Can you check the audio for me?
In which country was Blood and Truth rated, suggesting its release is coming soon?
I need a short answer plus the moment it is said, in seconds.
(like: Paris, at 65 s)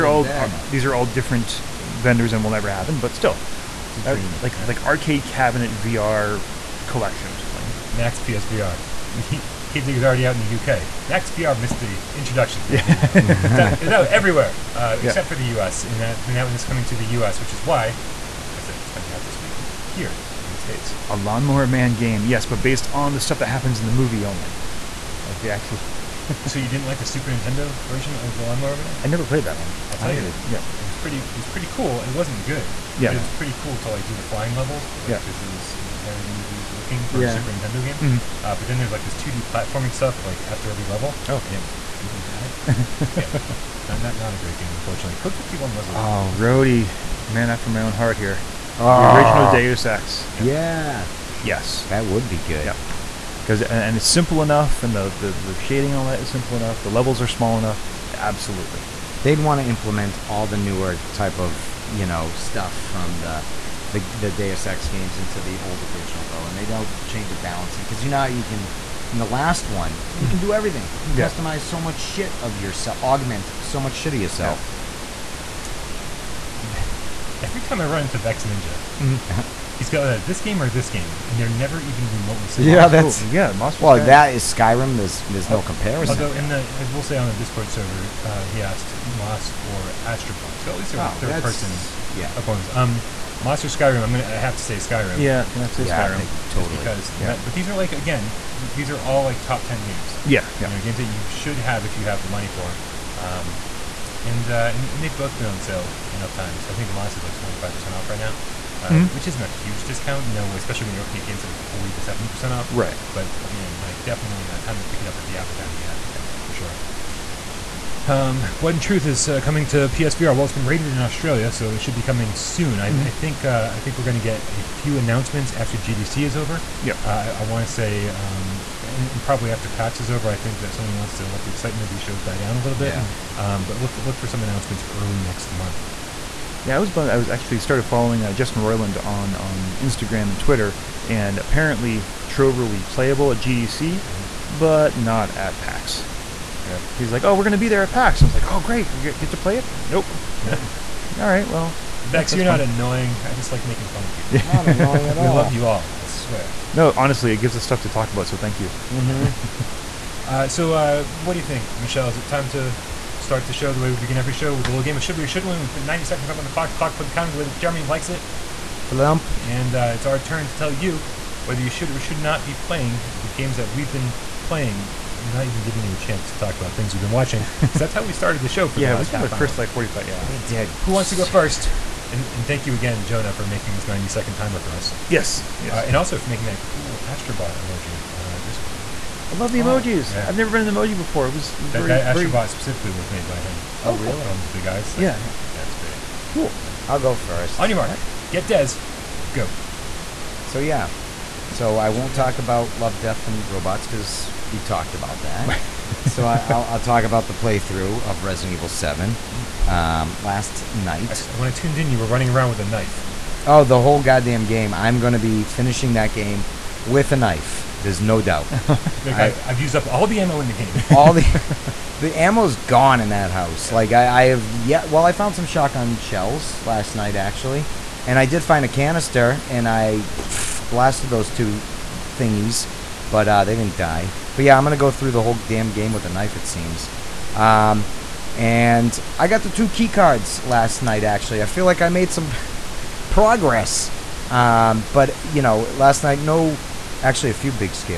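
Australia, at 120 s.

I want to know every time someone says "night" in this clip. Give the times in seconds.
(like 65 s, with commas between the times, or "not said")
210 s, 226 s, 240 s, 246 s.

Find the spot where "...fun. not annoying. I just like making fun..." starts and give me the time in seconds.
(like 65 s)
152 s.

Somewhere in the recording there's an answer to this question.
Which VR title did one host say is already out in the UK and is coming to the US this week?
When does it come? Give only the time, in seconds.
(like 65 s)
9 s.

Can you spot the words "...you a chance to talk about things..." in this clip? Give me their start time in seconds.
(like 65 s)
175 s.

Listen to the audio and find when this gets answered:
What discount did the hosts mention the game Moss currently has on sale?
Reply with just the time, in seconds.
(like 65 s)
107 s.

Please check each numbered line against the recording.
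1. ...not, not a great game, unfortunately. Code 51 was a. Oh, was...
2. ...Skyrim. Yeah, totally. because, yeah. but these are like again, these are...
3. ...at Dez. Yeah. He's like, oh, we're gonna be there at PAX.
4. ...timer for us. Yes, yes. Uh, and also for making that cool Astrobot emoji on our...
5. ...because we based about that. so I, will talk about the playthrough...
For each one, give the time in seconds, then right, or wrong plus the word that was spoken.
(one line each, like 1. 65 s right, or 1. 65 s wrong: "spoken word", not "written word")
1. 43 s right
2. 96 s right
3. 145 s wrong: "PAX", not "Dez"
4. 184 s right
5. 203 s wrong: "talked", not "based".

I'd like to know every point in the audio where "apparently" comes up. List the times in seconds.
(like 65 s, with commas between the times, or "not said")
141 s.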